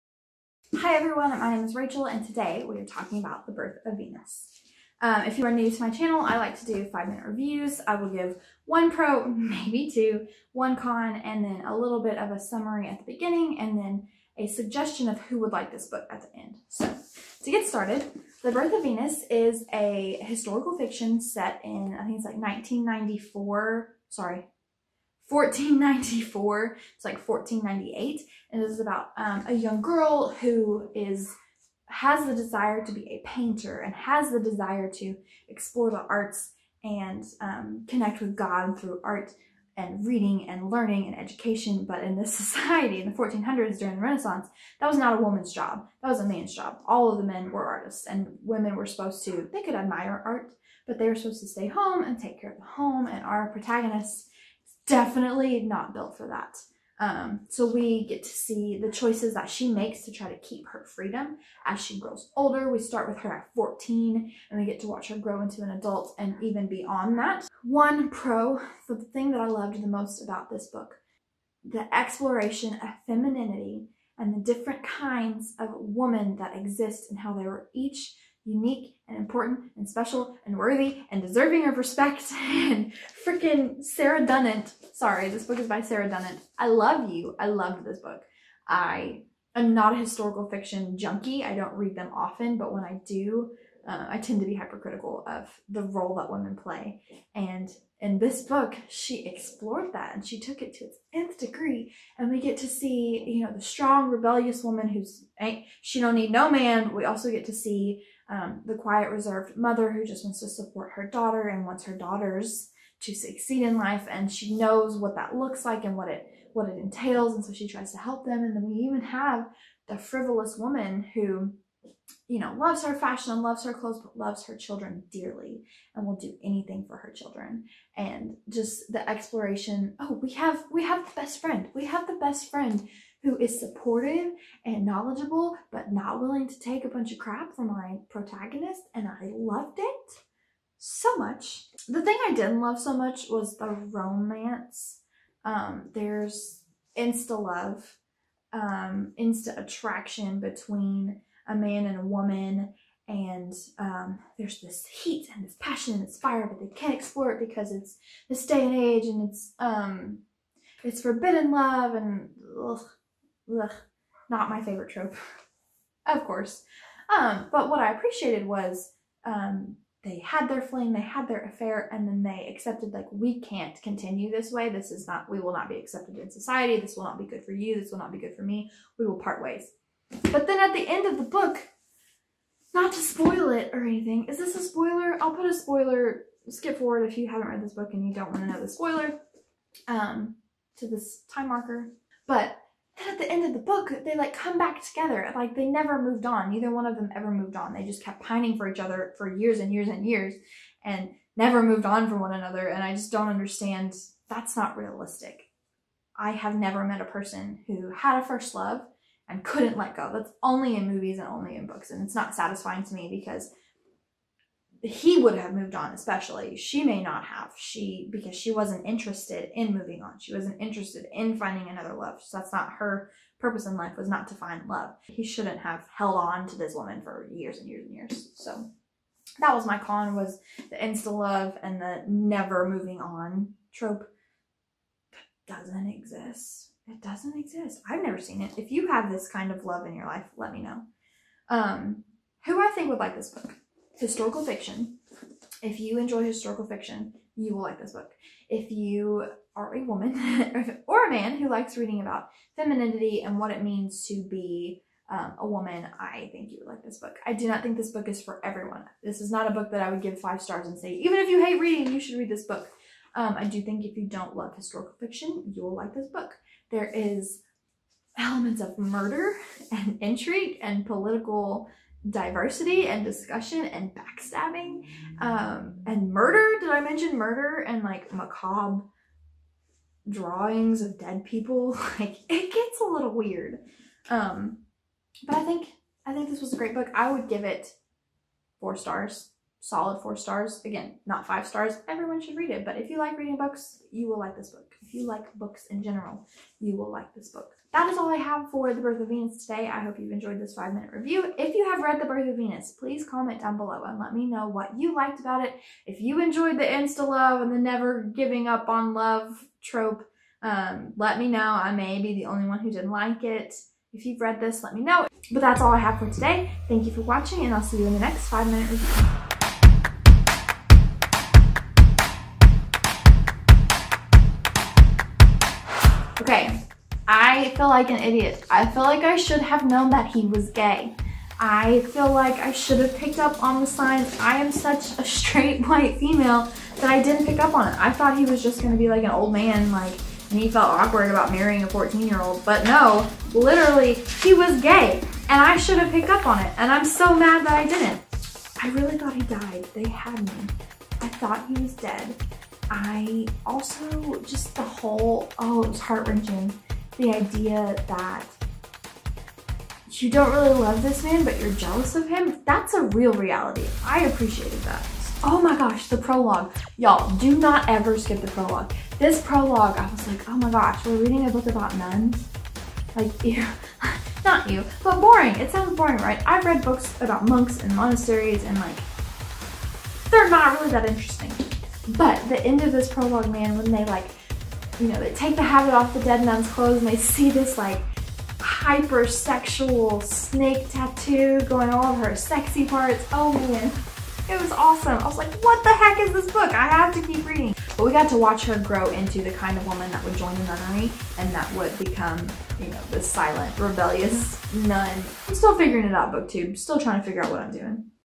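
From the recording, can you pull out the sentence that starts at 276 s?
Did I mention murder and like macabre drawings of dead people?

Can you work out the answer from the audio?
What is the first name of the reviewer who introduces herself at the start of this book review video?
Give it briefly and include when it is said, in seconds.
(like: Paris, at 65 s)
Rachel, at 1 s.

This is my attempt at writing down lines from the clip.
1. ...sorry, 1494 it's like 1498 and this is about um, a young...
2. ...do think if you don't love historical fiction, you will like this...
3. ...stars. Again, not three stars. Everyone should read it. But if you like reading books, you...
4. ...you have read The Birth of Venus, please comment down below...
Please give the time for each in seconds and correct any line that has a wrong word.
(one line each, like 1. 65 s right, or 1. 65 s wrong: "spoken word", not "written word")
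1. 24 s right
2. 263 s right
3. 290 s wrong: "five", not "three"
4. 301 s right.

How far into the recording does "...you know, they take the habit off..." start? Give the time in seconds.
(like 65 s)
384 s.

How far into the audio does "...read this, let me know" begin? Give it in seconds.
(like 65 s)
314 s.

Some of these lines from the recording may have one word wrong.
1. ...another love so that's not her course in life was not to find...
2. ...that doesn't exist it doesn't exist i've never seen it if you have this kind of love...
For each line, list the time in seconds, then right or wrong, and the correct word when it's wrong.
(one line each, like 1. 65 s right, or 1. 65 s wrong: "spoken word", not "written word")
1. 221 s wrong: "purpose", not "course"
2. 235 s right.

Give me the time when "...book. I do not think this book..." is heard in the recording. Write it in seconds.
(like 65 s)
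256 s.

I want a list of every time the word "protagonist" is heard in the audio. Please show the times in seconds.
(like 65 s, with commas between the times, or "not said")
53 s, 138 s.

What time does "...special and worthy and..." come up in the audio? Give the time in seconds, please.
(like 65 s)
79 s.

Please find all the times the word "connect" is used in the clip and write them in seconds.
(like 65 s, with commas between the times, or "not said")
37 s.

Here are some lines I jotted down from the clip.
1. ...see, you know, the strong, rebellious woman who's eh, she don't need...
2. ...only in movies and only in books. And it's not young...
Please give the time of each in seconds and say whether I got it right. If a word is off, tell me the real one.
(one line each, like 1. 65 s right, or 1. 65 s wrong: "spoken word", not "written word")
1. 102 s right
2. 210 s wrong: "satisfying", not "young".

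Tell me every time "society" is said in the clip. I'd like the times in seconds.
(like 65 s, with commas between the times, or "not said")
42 s, 176 s.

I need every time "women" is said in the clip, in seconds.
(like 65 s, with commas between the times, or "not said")
48 s, 75 s, 96 s.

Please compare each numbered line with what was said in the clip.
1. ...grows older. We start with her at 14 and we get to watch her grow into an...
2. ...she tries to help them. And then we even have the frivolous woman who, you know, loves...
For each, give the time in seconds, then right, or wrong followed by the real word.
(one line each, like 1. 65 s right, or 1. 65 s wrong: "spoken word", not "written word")
1. 61 s right
2. 117 s right.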